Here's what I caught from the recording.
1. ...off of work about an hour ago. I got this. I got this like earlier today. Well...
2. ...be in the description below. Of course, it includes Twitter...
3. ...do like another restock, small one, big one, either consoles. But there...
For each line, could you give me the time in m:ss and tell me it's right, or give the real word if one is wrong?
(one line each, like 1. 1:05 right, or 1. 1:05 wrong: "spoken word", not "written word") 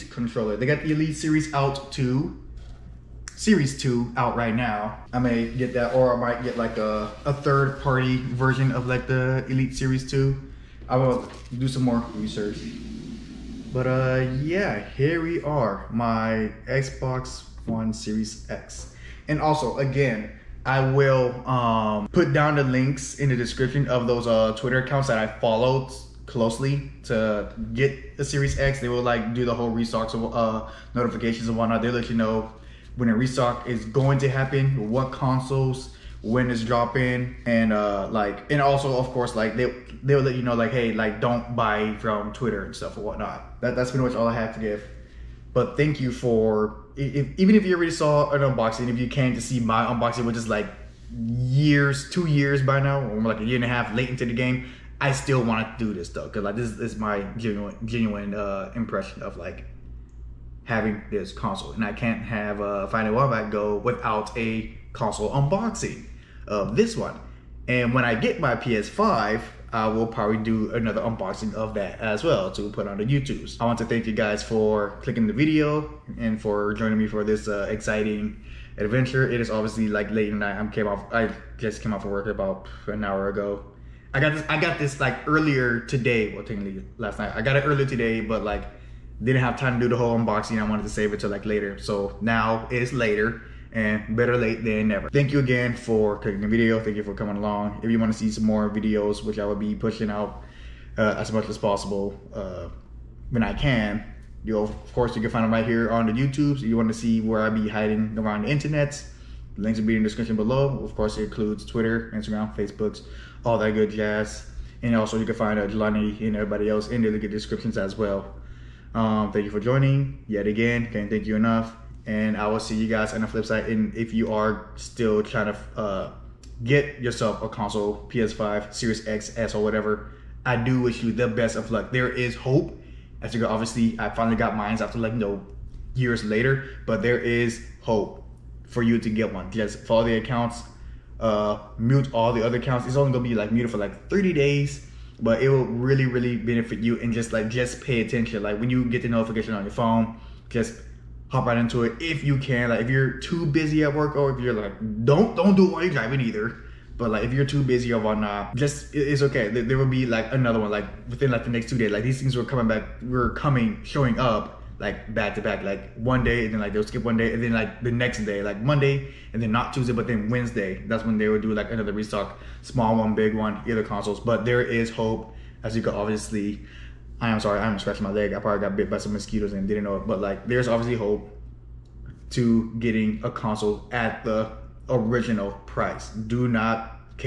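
1. 1:21 right
2. 1:49 right
3. 2:51 right.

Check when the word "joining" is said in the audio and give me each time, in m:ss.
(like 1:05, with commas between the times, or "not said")
1:16, 1:59.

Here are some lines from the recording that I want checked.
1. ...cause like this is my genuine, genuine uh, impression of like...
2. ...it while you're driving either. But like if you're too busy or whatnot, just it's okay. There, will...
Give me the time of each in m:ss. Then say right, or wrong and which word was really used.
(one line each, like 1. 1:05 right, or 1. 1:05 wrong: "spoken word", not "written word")
1. 0:56 right
2. 2:35 right.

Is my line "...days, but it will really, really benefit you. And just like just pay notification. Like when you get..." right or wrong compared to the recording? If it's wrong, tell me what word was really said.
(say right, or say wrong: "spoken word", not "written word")
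wrong: "attention", not "notification".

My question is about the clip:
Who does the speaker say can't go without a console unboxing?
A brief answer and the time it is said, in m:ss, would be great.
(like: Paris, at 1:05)
Fighting Wombat, at 1:02.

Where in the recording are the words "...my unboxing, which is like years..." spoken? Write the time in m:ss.
0:49.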